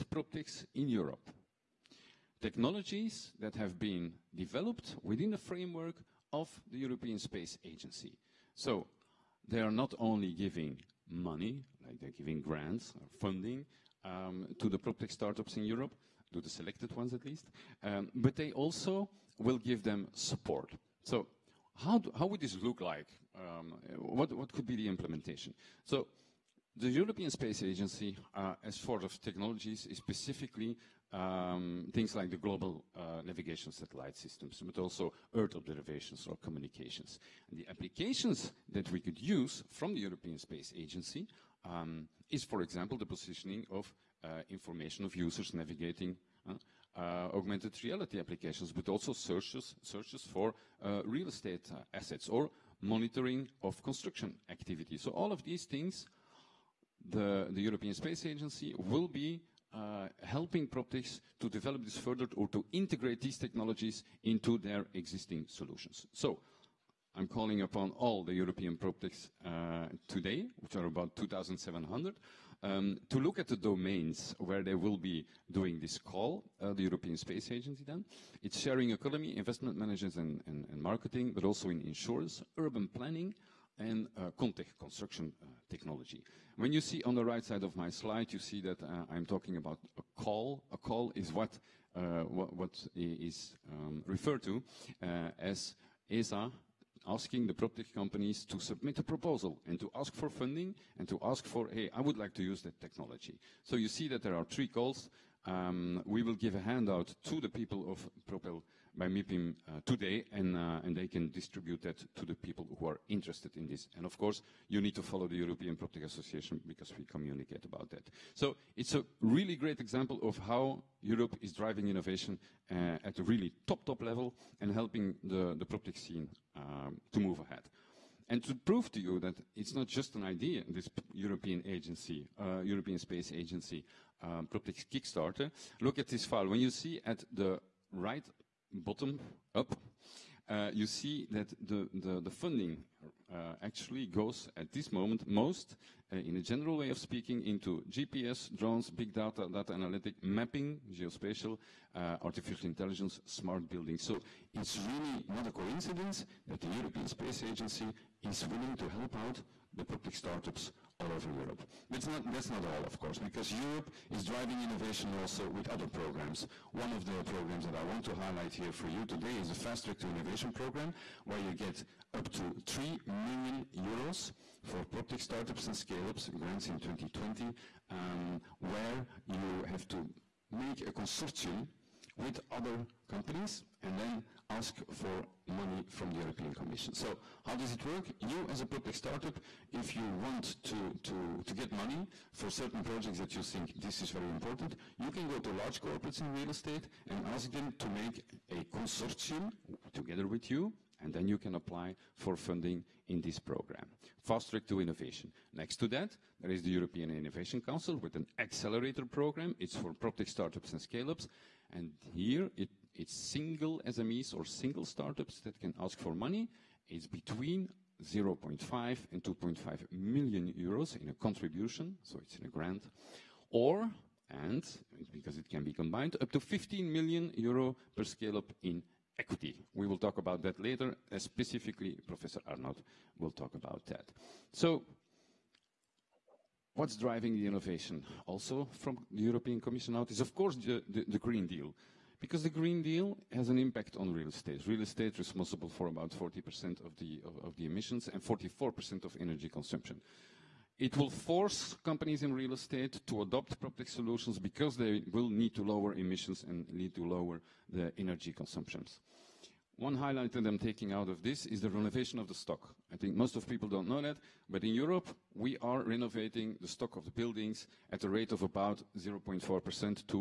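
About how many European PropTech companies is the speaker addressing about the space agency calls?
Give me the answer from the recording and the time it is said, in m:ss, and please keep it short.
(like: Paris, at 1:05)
2,700, at 1:11.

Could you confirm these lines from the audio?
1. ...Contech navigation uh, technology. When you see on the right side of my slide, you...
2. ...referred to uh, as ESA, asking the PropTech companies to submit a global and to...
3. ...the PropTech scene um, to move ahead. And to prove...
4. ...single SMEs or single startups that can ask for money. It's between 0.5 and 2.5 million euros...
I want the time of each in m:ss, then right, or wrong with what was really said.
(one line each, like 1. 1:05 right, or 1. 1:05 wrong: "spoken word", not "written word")
1. 1:24 wrong: "construction", not "navigation"
2. 1:34 wrong: "proposal", not "global"
3. 2:05 right
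4. 3:33 right.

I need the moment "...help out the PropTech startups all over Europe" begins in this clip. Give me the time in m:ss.
2:38.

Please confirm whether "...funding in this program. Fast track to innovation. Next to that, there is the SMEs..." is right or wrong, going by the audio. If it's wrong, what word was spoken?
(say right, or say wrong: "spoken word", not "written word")
wrong: "European", not "SMEs".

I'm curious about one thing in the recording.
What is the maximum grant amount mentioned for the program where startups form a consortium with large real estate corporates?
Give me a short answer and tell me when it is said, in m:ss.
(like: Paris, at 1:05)
3 million euros, at 2:52.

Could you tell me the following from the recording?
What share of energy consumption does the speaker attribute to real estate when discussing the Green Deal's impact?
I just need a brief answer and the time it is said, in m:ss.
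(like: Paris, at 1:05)
44%, at 4:08.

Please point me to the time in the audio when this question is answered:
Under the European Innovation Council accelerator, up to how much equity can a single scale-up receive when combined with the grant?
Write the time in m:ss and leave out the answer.
3:46.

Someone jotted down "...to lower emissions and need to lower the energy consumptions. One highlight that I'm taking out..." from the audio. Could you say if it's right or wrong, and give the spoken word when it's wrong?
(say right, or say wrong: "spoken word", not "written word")
right.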